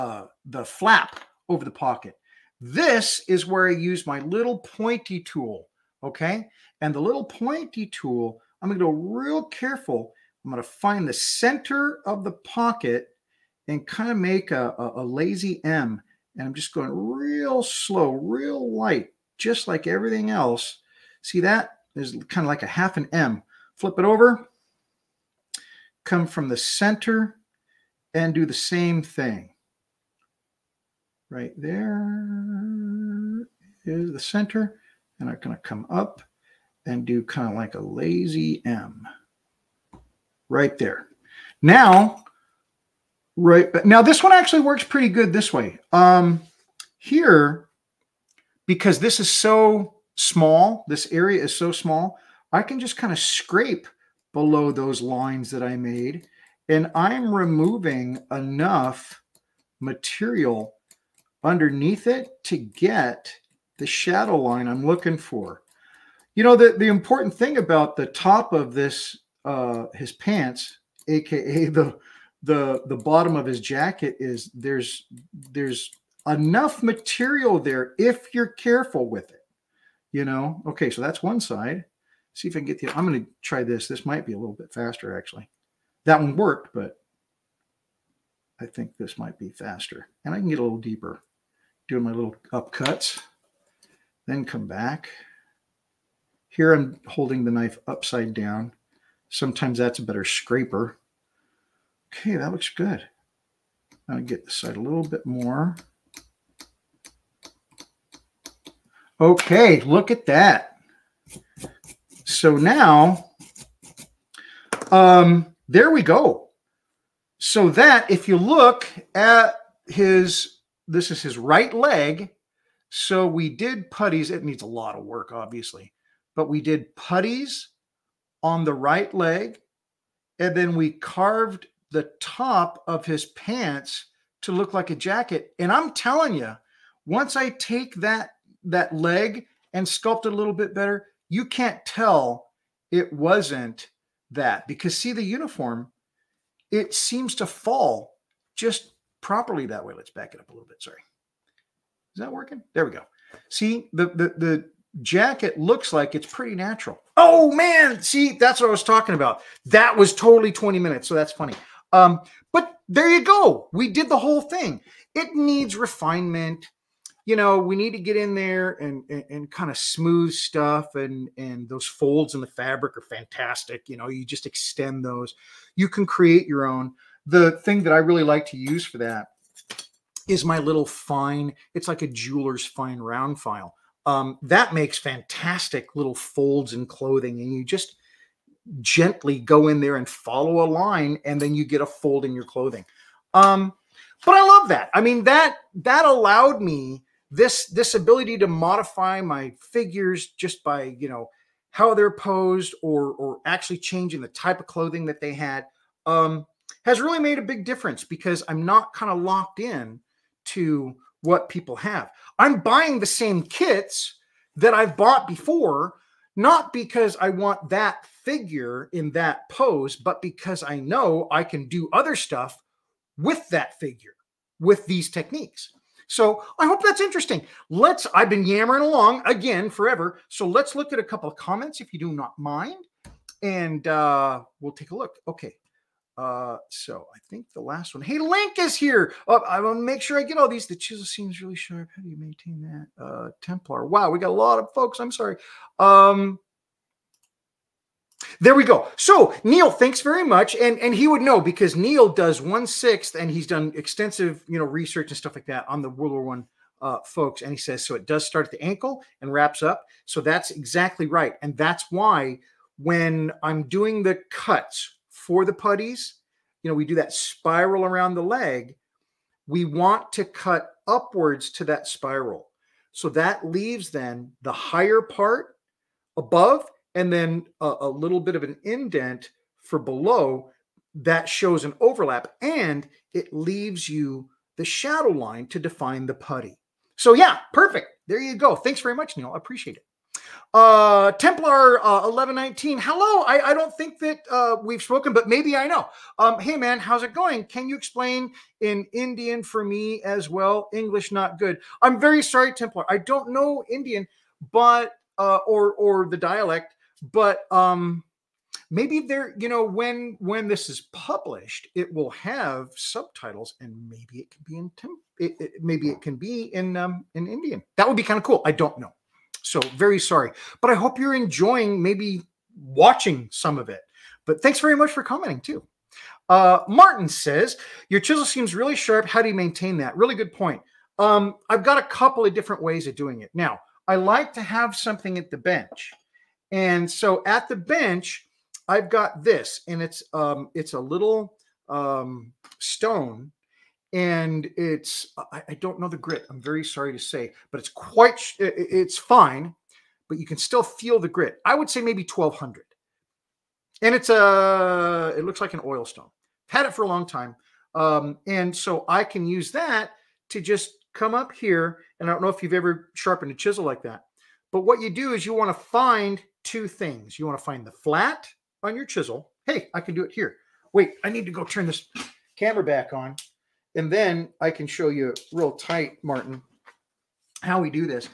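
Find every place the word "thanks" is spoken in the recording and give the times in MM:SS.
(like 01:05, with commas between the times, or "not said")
04:09, 04:48, 05:24.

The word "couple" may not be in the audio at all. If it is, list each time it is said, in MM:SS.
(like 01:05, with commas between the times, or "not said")
03:51, 05:31.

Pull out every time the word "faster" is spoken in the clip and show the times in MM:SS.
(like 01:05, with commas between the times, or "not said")
01:24, 01:29.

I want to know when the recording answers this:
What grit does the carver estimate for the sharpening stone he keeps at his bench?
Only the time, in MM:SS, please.
05:52.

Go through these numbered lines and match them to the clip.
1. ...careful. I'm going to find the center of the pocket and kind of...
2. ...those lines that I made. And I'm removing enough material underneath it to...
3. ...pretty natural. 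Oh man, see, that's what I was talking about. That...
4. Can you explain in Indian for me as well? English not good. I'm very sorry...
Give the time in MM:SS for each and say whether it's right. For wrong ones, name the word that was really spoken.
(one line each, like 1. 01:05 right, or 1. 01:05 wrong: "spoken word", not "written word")
1. 00:09 right
2. 00:54 right
3. 02:36 right
4. 04:57 right.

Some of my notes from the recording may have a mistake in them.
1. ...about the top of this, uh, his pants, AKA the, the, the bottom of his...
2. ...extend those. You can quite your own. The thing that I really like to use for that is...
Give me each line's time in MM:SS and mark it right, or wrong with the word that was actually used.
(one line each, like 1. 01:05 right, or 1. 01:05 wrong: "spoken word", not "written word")
1. 01:07 right
2. 02:54 wrong: "create", not "quite".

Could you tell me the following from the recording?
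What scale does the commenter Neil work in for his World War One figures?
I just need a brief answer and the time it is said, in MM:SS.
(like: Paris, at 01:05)
One sixth, at 04:12.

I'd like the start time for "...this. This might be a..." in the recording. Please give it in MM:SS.
01:23.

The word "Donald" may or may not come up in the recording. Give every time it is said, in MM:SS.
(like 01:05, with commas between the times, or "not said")
not said.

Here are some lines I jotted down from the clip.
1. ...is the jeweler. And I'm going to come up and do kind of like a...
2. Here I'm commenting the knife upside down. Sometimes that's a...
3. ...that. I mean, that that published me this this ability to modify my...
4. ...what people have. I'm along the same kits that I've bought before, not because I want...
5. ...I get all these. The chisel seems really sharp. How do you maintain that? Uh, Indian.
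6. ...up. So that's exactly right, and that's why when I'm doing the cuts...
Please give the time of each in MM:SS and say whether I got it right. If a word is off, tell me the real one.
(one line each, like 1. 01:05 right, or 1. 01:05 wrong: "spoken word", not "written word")
1. 00:33 wrong: "center", not "jeweler"
2. 01:36 wrong: "holding", not "commenting"
3. 03:14 wrong: "allowed", not "published"
4. 03:31 wrong: "buying", not "along"
5. 04:00 wrong: "Templar", not "Indian"
6. 04:19 right.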